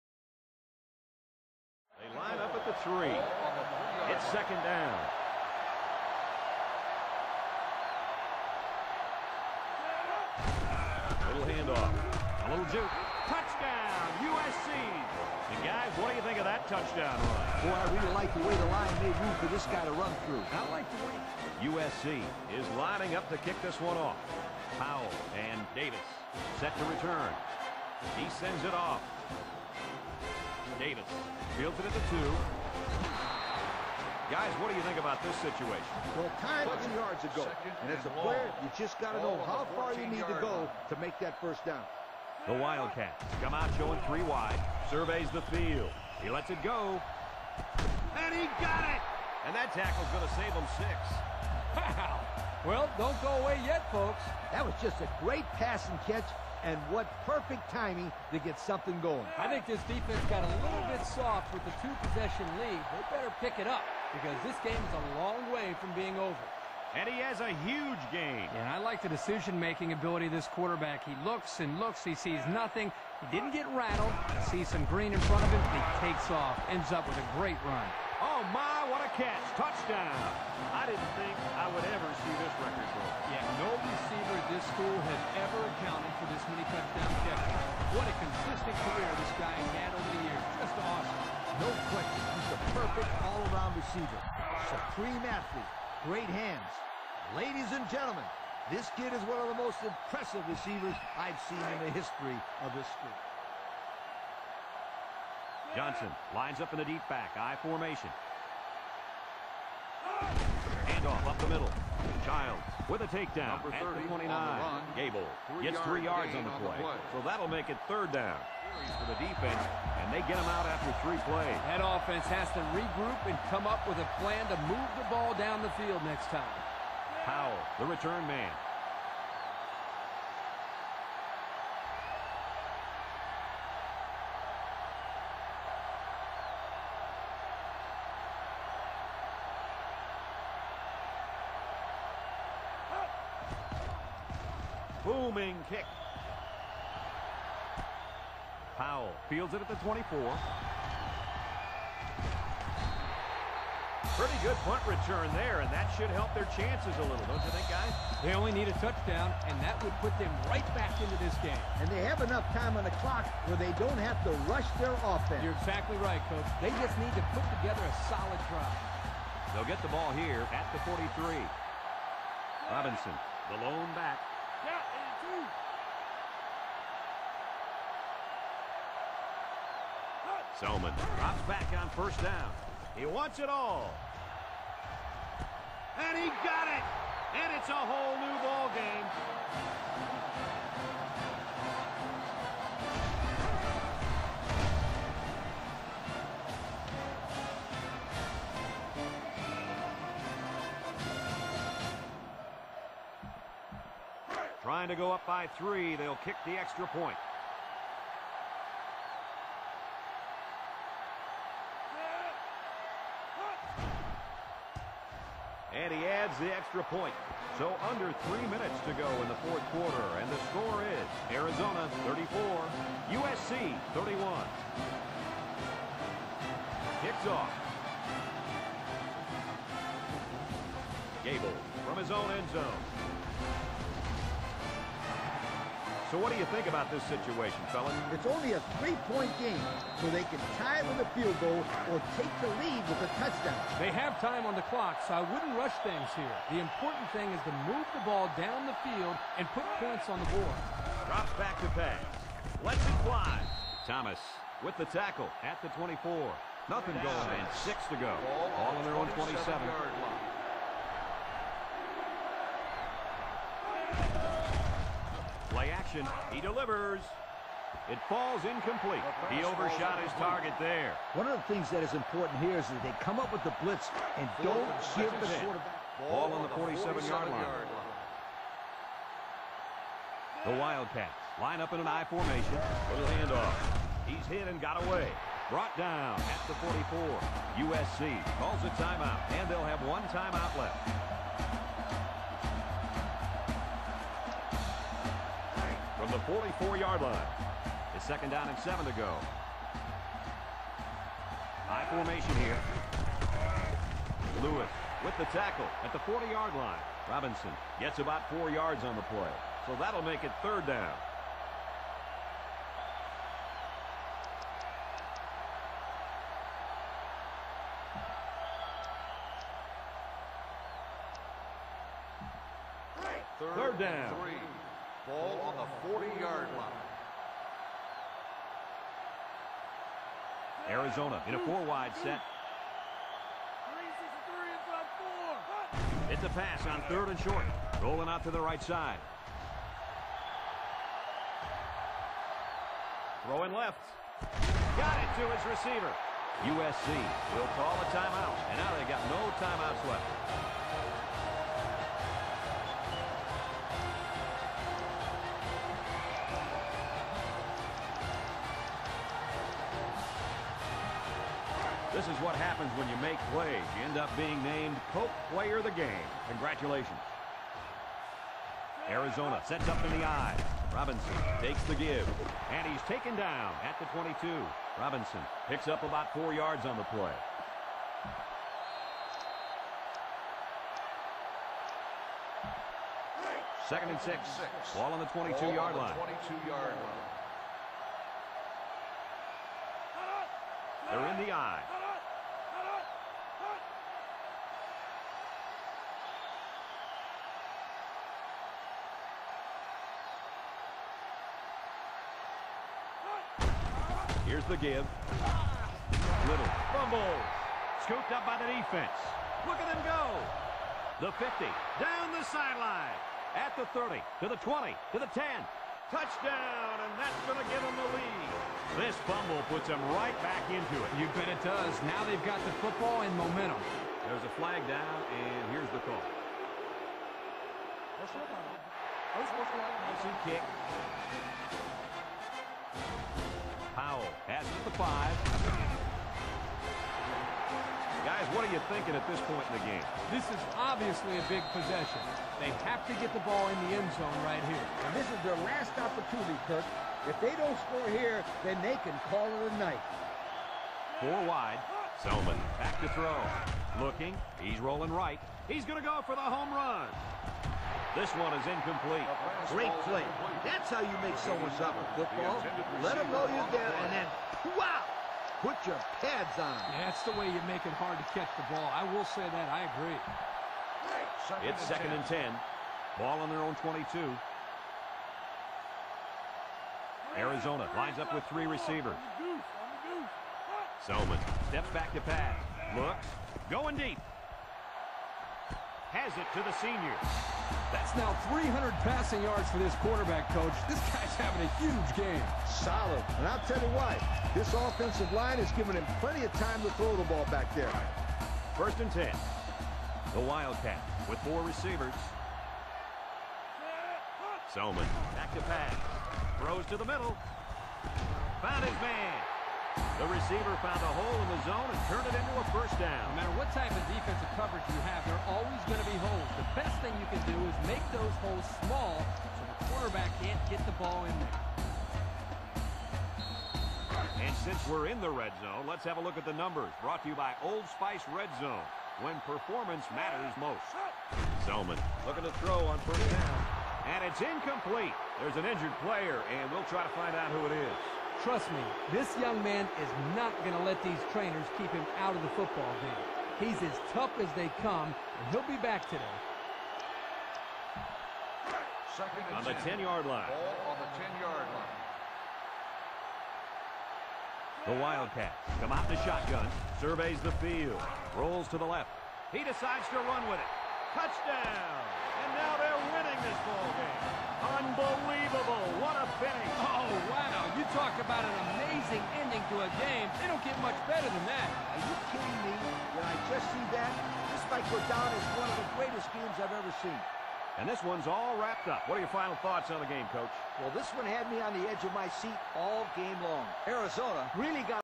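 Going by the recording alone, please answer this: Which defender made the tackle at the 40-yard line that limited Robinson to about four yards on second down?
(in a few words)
Lewis.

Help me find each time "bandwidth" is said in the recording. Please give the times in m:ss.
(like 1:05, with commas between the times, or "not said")
not said.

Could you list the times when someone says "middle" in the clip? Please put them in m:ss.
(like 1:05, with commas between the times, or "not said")
1:51, 8:26.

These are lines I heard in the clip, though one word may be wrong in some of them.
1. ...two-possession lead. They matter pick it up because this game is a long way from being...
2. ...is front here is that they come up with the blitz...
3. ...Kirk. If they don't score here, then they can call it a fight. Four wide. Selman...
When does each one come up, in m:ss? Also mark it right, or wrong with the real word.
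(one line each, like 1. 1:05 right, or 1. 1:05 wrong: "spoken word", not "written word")
1. 1:01 wrong: "better", not "matter"
2. 4:31 wrong: "important", not "front"
3. 7:26 wrong: "night", not "fight".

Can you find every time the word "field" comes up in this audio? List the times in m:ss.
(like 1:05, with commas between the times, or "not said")
0:31, 0:45, 2:05, 2:29, 4:01, 4:08, 9:17.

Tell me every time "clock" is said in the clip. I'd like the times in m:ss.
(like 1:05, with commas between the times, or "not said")
2:43, 4:04.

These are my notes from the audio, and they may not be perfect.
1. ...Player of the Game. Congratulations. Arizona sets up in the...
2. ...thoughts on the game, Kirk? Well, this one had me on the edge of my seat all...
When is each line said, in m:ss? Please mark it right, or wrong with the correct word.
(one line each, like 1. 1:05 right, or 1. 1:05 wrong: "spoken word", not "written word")
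1. 6:05 right
2. 9:39 wrong: "Coach", not "Kirk".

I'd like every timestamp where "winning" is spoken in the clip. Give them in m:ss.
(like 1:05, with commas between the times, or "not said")
9:22.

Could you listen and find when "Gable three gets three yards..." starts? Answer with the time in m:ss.
1:54.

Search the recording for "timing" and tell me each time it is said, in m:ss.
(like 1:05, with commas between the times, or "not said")
0:57.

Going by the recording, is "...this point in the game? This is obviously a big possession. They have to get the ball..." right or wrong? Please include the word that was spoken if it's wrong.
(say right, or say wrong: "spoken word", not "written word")
right.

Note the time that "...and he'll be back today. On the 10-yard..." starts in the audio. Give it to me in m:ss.
9:04.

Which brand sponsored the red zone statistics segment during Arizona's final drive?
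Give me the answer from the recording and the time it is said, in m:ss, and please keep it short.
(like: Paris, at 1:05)
Old Spice, at 8:47.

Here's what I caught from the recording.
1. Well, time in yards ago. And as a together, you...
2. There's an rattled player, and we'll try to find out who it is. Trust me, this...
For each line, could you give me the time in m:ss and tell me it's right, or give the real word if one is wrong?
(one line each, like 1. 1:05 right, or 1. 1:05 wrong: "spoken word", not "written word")
1. 0:36 wrong: "player", not "together"
2. 8:55 wrong: "injured", not "rattled".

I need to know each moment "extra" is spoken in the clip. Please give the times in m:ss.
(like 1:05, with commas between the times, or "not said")
3:26, 3:36.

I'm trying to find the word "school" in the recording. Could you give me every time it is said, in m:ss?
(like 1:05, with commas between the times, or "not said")
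1:24, 1:42.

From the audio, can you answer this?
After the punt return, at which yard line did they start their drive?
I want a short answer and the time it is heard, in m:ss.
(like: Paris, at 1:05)
43, at 2:50.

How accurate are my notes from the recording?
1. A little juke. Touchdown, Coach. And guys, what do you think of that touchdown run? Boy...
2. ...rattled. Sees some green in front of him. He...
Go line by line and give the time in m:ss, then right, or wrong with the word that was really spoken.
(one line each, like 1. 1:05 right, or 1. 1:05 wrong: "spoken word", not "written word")
1. 0:12 wrong: "USC", not "Coach"
2. 1:13 right.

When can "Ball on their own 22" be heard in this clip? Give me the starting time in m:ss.
7:52.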